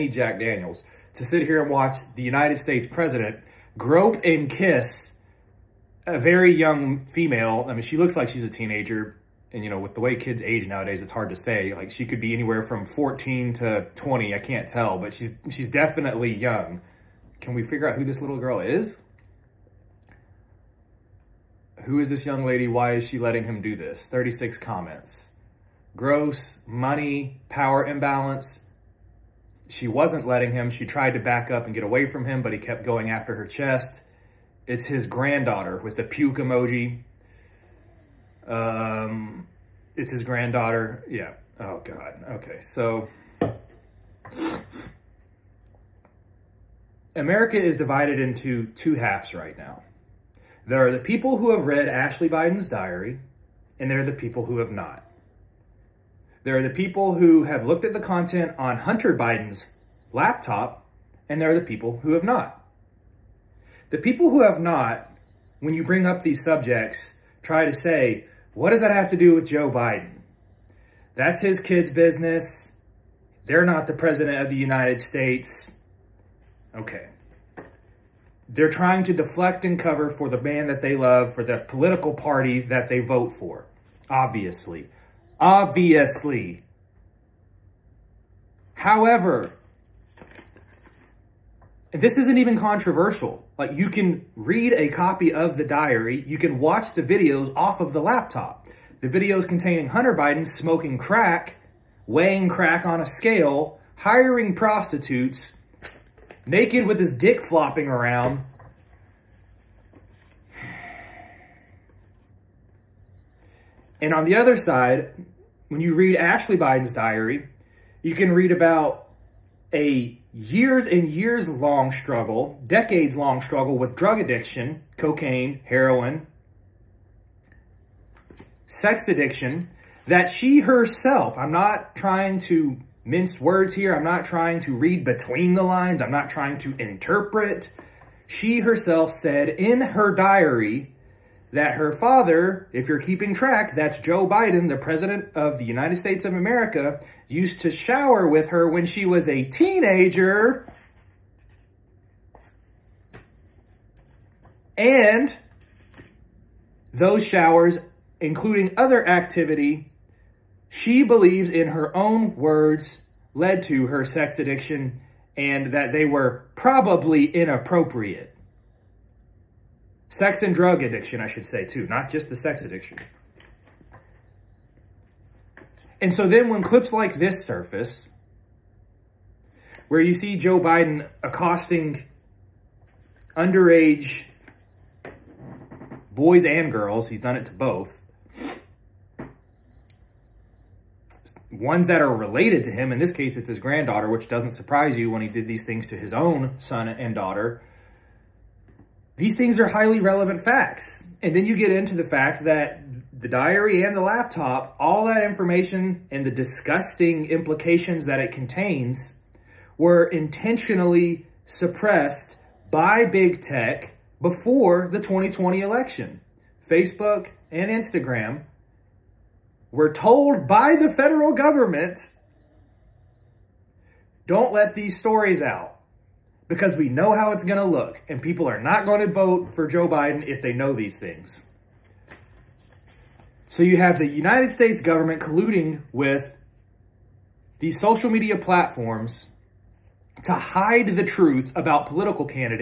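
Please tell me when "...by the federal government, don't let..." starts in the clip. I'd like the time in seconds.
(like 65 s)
220 s.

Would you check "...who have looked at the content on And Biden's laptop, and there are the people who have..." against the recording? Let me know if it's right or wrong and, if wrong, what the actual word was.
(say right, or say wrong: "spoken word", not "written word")
wrong: "Hunter", not "And".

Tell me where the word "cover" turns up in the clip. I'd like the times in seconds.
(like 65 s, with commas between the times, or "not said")
79 s.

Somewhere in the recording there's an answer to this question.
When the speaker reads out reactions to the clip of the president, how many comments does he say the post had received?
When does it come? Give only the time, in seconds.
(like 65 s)
24 s.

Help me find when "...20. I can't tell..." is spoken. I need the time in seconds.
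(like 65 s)
13 s.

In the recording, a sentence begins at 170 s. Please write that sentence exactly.
Sex and drug addiction, I should say, too, not just the sex addiction.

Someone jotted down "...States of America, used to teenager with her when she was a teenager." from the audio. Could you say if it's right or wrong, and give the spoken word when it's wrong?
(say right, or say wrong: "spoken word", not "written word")
wrong: "shower", not "teenager".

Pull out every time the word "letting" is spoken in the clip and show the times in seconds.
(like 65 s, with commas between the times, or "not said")
23 s, 30 s.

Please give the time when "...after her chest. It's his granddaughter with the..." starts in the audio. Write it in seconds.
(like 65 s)
33 s.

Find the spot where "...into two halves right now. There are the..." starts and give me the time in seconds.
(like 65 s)
48 s.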